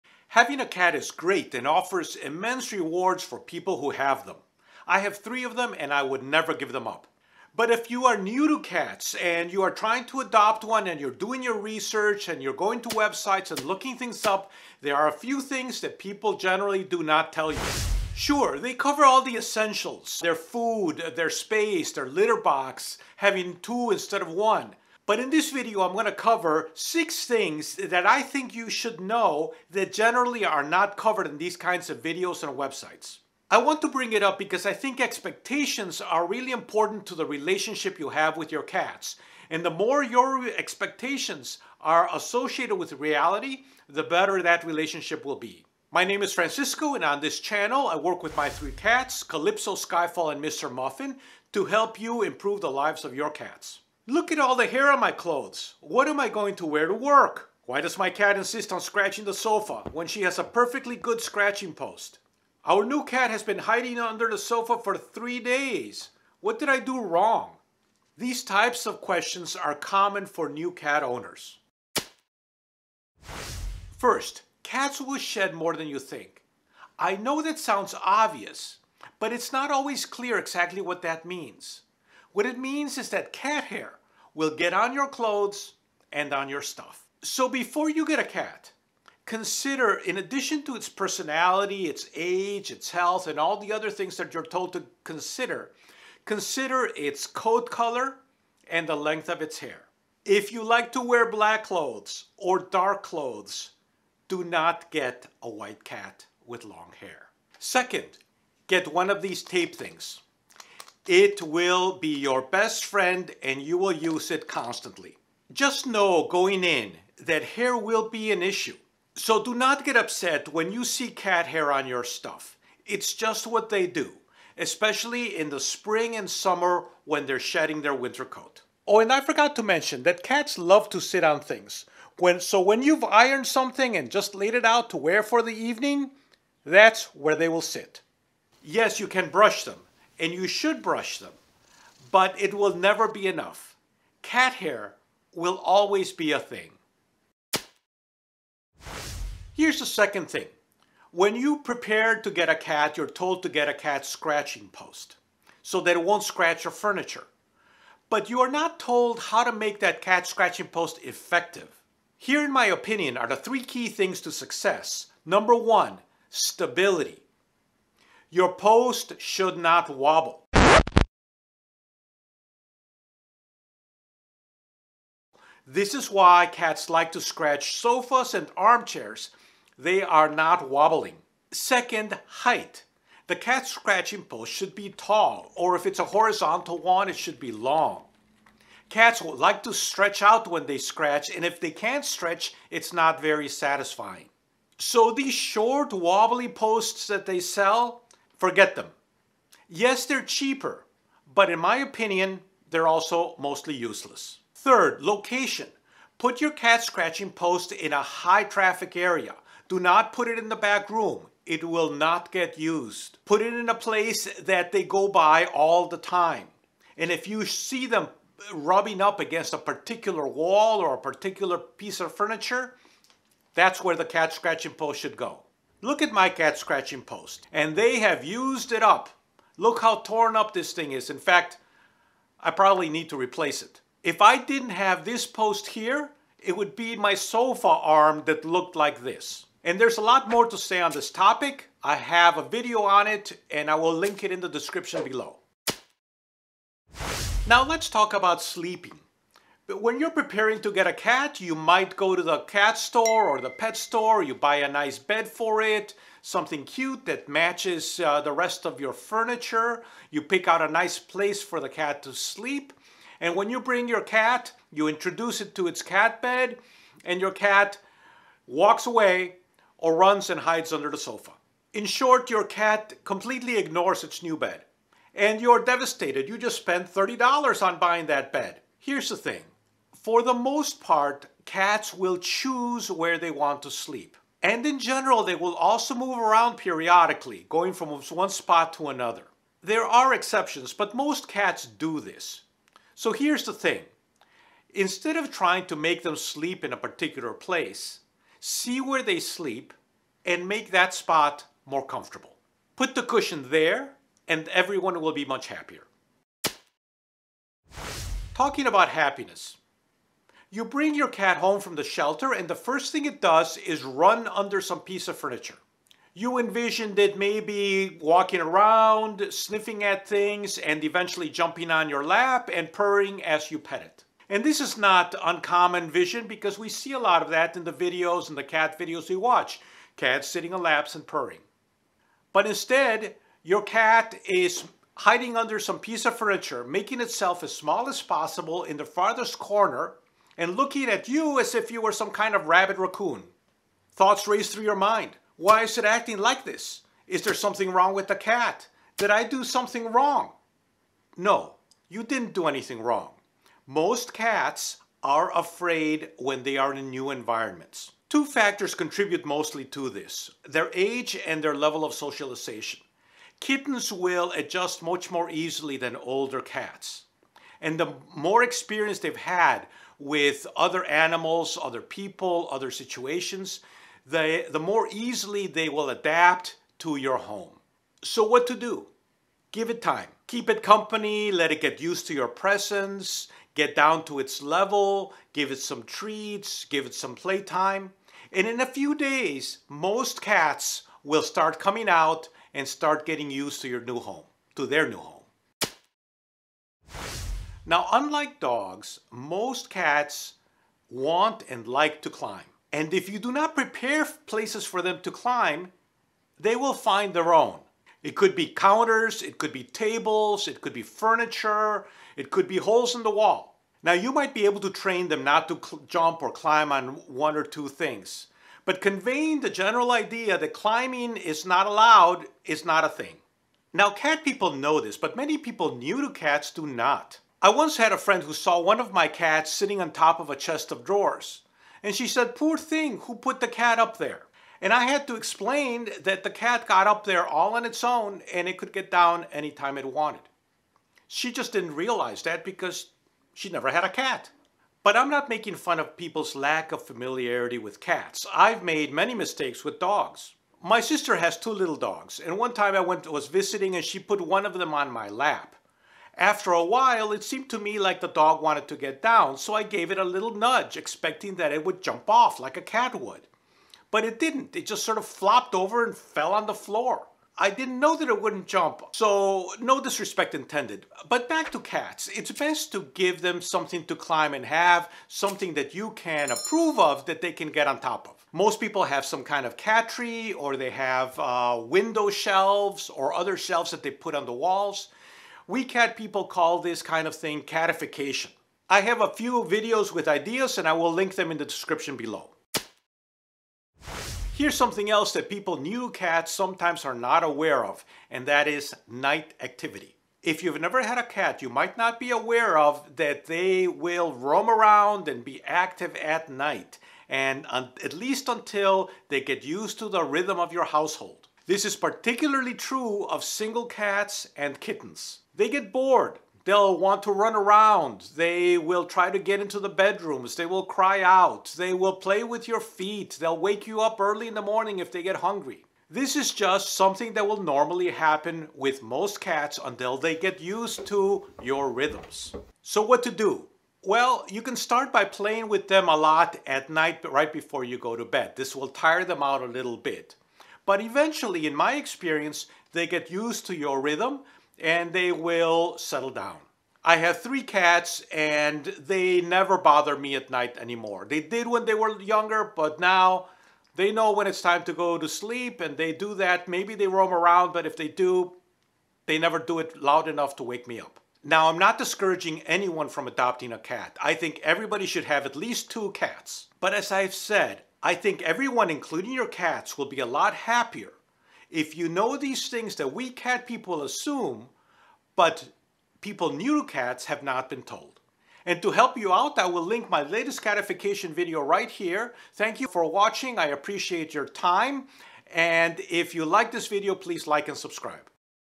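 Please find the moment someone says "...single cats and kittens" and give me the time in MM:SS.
08:33.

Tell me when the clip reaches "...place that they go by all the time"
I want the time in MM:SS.
03:33.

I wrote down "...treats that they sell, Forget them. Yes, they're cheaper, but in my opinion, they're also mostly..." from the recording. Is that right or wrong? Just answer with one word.
wrong.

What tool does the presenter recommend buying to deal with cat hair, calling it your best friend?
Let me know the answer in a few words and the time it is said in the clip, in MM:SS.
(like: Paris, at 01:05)
tape things, at 01:49.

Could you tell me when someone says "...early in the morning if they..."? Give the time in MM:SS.
08:43.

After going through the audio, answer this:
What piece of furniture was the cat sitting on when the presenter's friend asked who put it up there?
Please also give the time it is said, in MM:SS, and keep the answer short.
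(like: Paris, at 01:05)
Chest of drawers, at 07:10.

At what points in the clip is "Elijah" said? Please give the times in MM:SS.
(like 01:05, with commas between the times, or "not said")
not said.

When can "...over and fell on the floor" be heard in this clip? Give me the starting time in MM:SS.
07:45.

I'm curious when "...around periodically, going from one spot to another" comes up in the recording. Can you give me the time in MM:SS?
04:46.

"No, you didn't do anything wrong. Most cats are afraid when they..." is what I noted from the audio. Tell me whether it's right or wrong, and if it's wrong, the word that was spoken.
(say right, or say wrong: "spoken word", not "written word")
right.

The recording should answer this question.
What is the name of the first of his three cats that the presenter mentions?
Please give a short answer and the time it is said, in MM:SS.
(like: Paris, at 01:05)
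Calypso, at 00:49.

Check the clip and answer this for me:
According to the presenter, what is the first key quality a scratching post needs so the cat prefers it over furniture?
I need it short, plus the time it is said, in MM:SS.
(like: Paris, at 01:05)
Stability, at 02:46.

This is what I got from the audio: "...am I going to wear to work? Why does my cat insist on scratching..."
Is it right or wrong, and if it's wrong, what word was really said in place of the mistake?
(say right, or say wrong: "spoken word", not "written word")
right.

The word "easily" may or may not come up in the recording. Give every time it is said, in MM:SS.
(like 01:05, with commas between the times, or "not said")
06:05, 06:14.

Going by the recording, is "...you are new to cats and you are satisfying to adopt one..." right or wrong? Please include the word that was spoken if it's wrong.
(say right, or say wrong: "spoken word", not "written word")
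wrong: "trying", not "satisfying".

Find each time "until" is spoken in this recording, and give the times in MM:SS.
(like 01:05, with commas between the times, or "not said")
08:28, 08:49.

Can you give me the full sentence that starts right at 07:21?
She just didn't realize that because she never had a cat.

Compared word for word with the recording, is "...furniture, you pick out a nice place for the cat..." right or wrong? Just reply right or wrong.
right.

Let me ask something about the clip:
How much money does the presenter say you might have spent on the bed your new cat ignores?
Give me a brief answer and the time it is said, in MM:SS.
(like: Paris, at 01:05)
$30, at 04:36.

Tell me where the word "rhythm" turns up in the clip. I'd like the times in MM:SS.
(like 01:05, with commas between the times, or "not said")
08:30, 08:51, 09:03.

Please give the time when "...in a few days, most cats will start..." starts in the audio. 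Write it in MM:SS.
06:28.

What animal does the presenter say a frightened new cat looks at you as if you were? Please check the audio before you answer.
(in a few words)
Rabid raccoon.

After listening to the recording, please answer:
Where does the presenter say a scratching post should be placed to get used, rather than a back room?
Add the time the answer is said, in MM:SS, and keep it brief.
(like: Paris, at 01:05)
High traffic area, at 03:28.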